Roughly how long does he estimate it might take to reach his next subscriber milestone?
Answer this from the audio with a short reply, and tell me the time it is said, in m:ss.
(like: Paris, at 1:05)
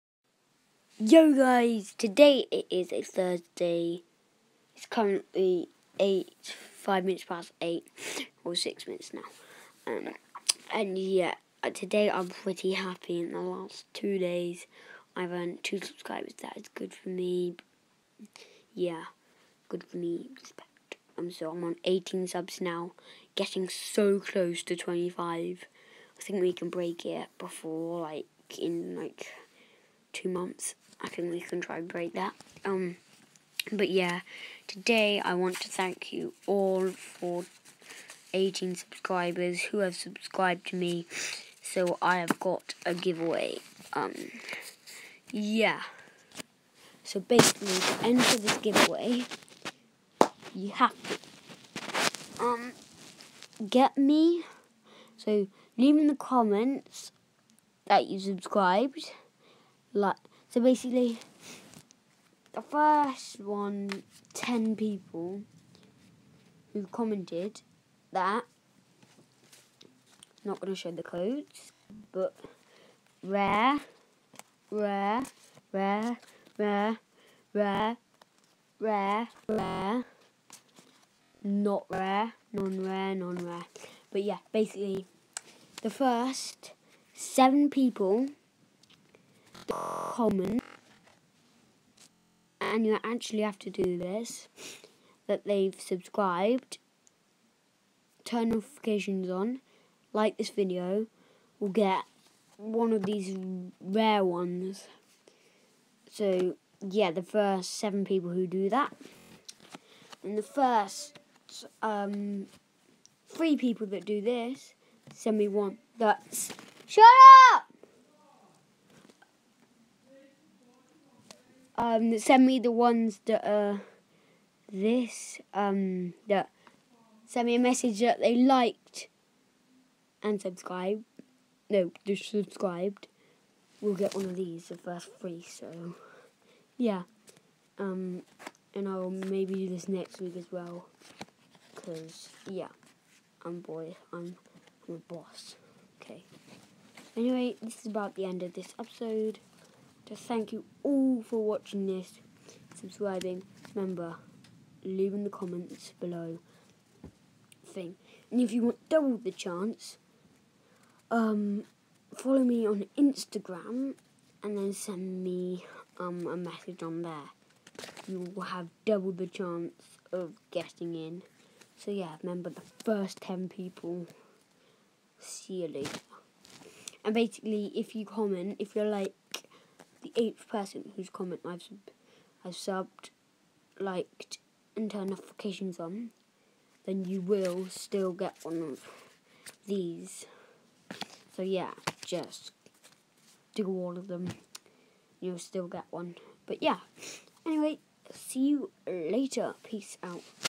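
2 months, at 0:30.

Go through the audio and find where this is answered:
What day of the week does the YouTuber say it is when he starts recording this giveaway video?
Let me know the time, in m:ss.
0:03.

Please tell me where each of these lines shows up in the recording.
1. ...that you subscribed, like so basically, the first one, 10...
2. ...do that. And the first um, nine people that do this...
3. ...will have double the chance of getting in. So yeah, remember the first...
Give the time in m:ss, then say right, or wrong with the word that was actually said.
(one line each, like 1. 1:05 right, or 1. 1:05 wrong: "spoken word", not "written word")
1. 0:57 right
2. 1:48 wrong: "three", not "nine"
3. 2:48 right.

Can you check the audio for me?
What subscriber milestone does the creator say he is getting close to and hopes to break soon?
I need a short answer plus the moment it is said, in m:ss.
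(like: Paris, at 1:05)
25, at 0:24.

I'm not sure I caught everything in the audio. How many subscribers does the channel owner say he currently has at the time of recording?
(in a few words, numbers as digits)
18.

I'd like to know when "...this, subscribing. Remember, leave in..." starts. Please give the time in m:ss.
2:31.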